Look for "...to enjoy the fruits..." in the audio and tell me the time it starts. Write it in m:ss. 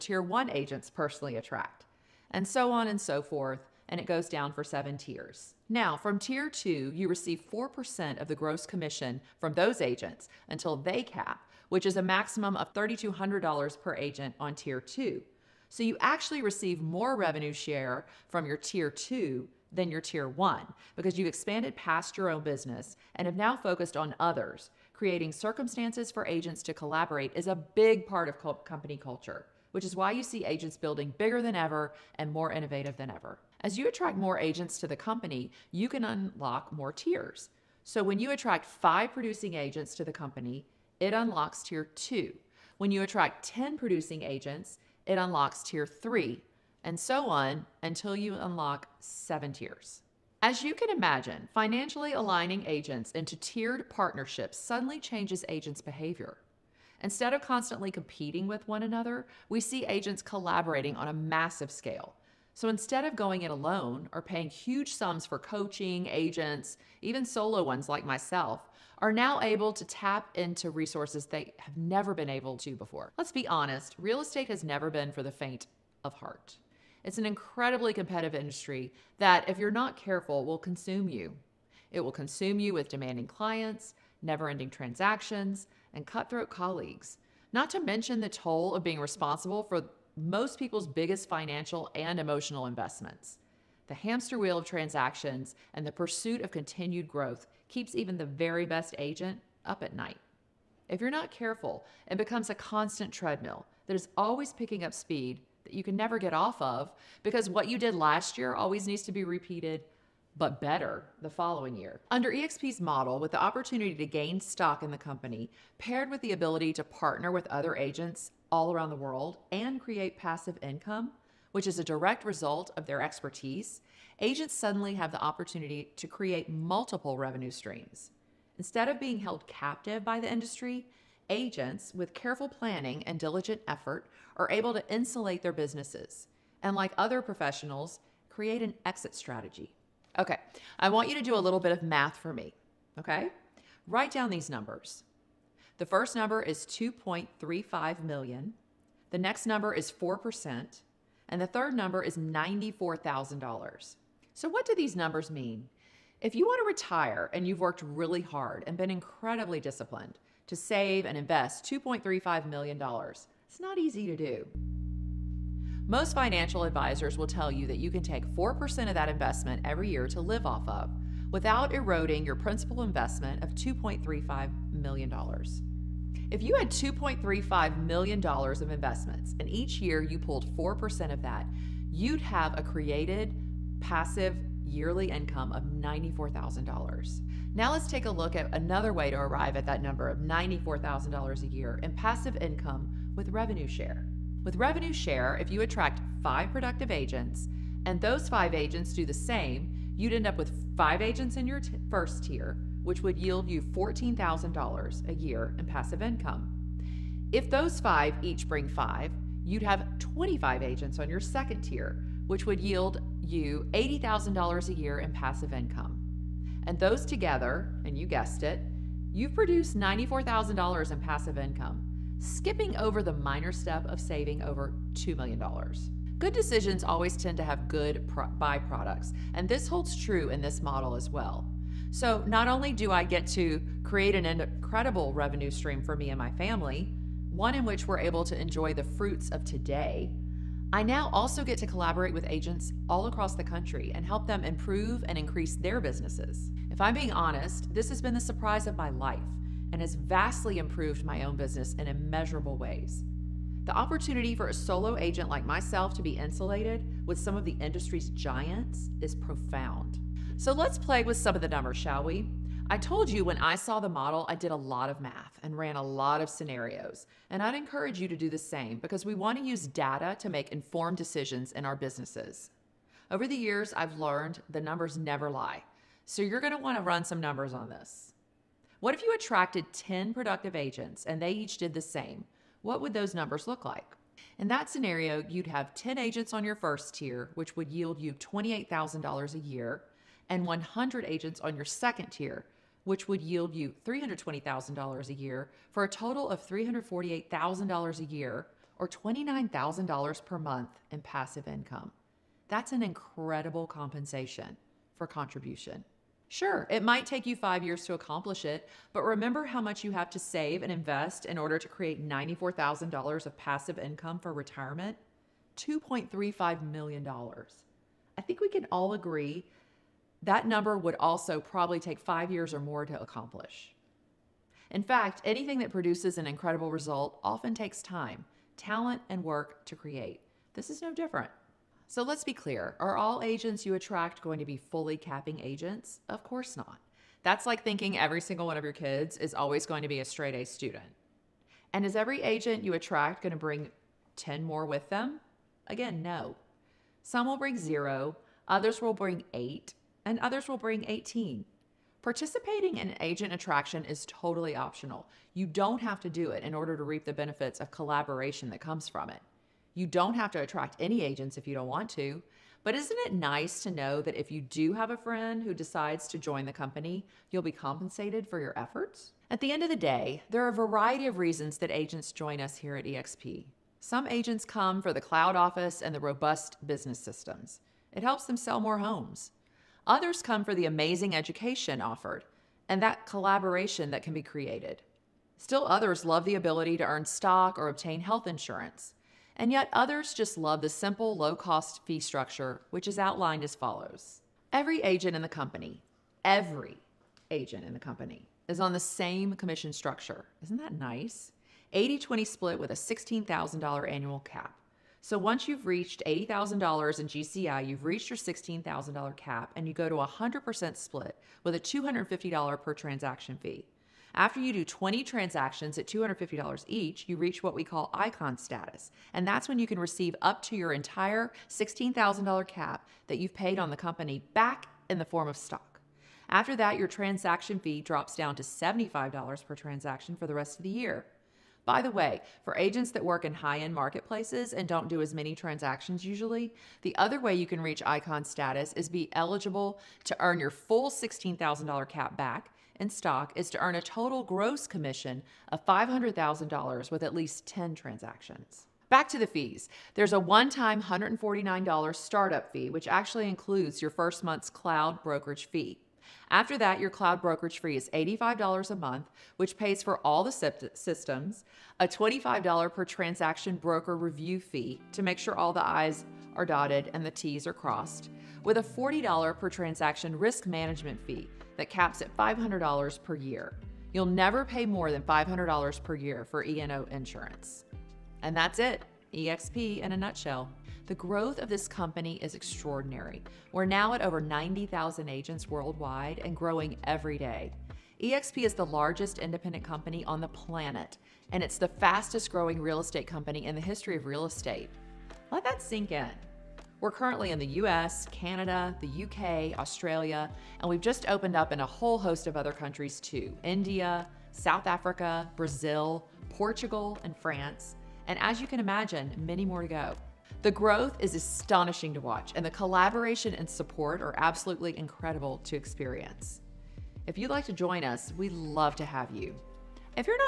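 3:58.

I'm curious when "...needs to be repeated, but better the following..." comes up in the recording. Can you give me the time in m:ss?
1:48.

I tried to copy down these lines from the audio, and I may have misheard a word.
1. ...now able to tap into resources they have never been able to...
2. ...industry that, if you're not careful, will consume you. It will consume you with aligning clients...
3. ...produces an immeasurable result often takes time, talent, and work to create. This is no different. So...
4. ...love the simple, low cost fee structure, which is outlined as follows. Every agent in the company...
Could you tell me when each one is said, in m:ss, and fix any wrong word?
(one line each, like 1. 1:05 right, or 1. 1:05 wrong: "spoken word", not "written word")
1. 1:09 right
2. 1:18 wrong: "demanding", not "aligning"
3. 5:25 wrong: "incredible", not "immeasurable"
4. 6:30 right.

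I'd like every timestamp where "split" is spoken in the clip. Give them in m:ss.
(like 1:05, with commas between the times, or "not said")
6:42, 6:50.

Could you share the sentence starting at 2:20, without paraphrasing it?
Okay, I want you to do a little bit of math for me, okay?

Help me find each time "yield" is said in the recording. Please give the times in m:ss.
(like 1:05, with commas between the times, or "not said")
3:23, 3:32, 4:47, 4:53.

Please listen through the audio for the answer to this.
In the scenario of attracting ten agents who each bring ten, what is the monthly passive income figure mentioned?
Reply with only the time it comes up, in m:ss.
4:58.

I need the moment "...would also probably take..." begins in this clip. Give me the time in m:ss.
5:20.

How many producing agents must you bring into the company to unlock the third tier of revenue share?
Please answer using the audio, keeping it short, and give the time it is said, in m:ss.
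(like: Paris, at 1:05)
10, at 0:43.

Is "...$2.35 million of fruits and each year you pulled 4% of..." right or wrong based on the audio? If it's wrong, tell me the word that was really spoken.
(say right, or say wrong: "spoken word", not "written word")
wrong: "investments", not "fruits".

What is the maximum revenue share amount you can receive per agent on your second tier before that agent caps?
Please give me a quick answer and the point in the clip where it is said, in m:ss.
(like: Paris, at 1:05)
$3,200, at 0:12.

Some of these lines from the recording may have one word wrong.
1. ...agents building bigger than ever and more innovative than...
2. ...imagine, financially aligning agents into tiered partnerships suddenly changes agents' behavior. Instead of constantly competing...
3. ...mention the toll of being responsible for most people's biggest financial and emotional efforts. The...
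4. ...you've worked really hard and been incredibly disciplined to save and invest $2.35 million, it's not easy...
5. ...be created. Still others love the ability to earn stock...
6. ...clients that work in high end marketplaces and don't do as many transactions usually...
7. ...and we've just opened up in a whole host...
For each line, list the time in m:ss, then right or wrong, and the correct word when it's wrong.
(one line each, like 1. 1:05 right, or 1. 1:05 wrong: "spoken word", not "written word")
1. 0:30 right
2. 0:50 right
3. 1:27 wrong: "investments", not "efforts"
4. 2:37 right
5. 6:24 right
6. 7:12 wrong: "agents", not "clients"
7. 8:20 right.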